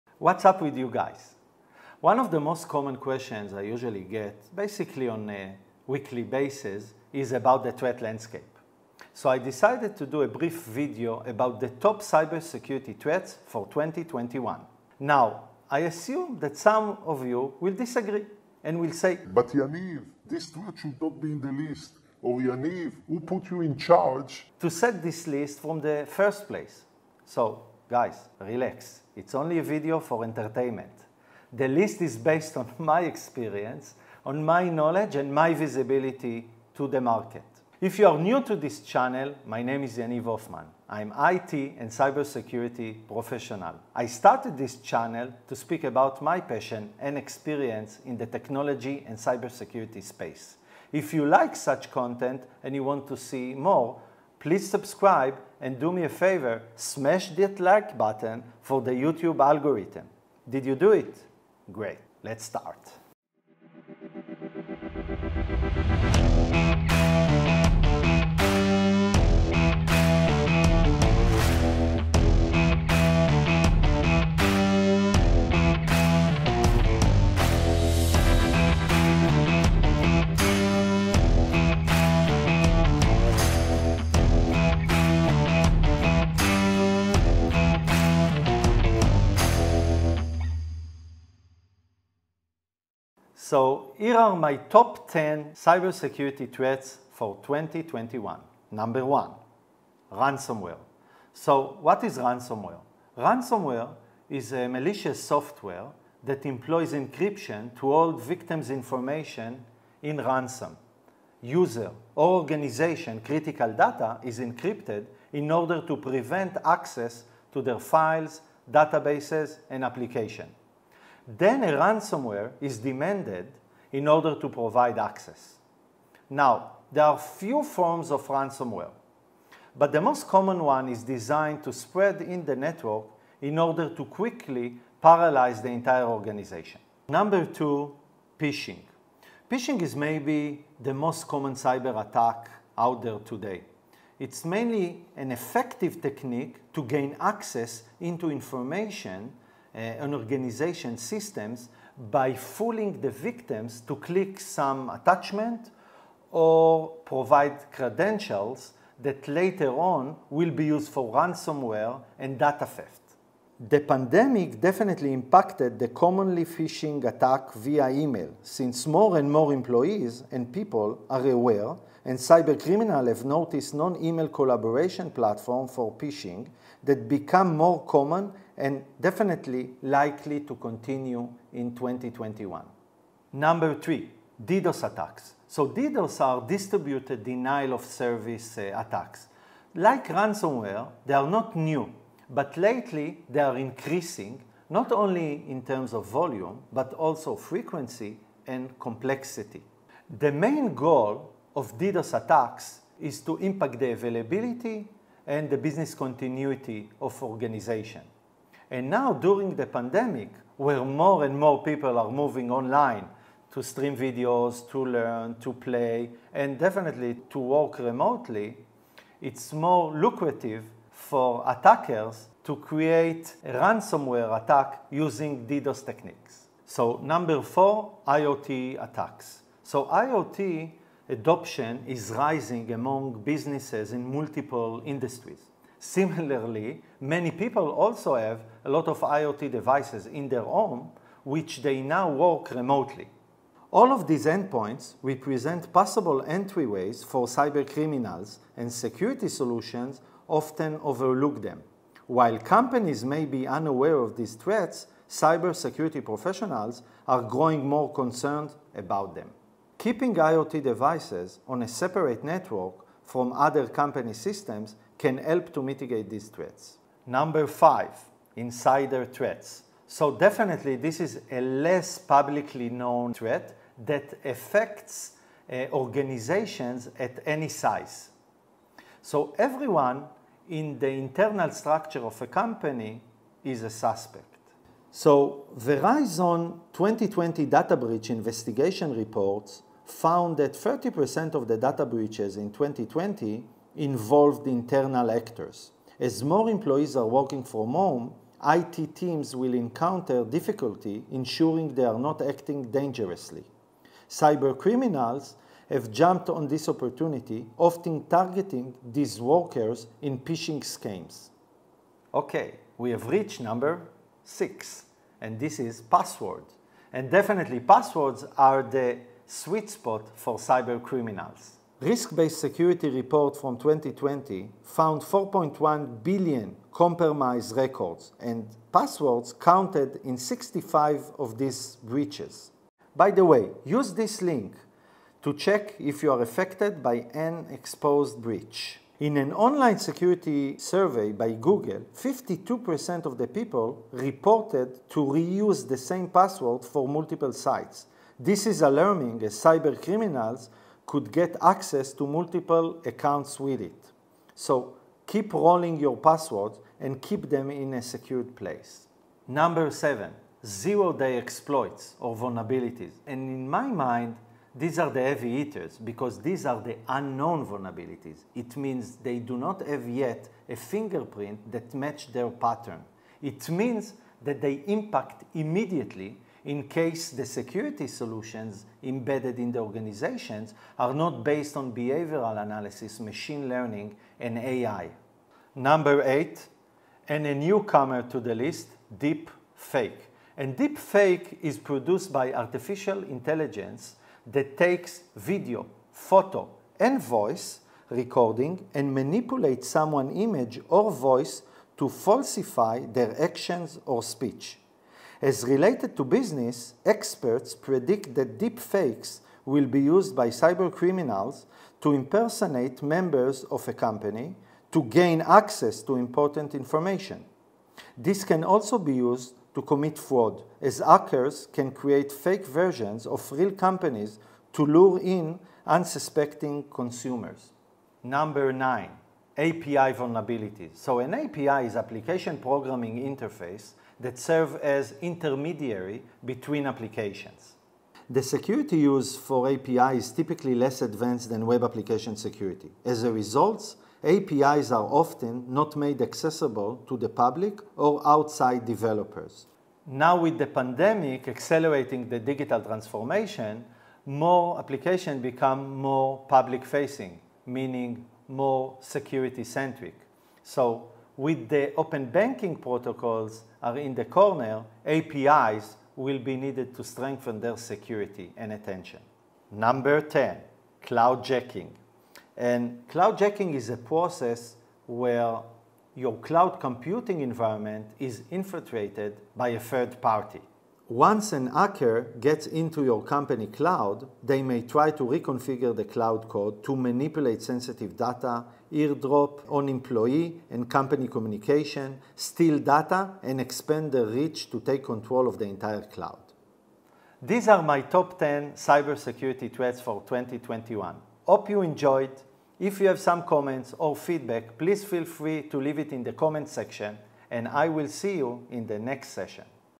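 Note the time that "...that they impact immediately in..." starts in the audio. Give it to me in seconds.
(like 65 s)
374 s.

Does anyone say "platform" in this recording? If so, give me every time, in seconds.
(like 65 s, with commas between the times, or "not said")
175 s.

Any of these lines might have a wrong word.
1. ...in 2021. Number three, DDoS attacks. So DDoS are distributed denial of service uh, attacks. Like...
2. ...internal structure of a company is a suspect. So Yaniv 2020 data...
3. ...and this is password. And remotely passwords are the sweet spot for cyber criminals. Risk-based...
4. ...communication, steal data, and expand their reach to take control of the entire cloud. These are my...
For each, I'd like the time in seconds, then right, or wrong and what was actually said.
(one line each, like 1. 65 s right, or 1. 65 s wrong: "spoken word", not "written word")
1. 181 s right
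2. 280 s wrong: "Verizon", not "Yaniv"
3. 315 s wrong: "definitely", not "remotely"
4. 491 s right.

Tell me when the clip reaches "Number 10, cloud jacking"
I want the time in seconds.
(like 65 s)
469 s.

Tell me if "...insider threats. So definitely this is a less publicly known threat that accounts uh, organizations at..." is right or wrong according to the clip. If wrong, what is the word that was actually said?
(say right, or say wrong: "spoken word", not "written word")
wrong: "affects", not "accounts".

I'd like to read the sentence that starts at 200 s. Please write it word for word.
The main goal of DDoS attacks is to impact the availability and the business continuity of organization.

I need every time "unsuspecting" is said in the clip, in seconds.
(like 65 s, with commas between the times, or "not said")
425 s.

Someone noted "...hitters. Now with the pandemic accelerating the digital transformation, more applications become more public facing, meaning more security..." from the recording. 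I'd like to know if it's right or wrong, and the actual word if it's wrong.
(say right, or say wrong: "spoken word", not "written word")
wrong: "developers", not "hitters".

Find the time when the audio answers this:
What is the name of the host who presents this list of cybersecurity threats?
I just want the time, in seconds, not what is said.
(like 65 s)
39 s.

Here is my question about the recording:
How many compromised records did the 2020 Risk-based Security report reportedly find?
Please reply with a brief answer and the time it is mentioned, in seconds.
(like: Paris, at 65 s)
4.1 billion, at 325 s.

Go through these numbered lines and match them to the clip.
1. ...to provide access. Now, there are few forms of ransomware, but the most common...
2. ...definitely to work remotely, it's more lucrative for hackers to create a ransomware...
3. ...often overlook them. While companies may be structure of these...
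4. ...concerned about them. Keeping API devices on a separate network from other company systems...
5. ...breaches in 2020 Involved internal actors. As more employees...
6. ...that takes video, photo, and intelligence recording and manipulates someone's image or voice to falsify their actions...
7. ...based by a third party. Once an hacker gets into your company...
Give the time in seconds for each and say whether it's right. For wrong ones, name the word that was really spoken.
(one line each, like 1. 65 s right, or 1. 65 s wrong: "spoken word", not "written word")
1. 124 s right
2. 216 s wrong: "attackers", not "hackers"
3. 250 s wrong: "unaware", not "structure"
4. 257 s wrong: "IoT", not "API"
5. 291 s right
6. 394 s wrong: "voice", not "intelligence"
7. 478 s wrong: "infiltrated", not "based".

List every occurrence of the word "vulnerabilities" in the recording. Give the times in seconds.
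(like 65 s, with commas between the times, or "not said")
362 s, 367 s, 429 s.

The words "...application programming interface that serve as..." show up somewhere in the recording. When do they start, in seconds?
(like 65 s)
431 s.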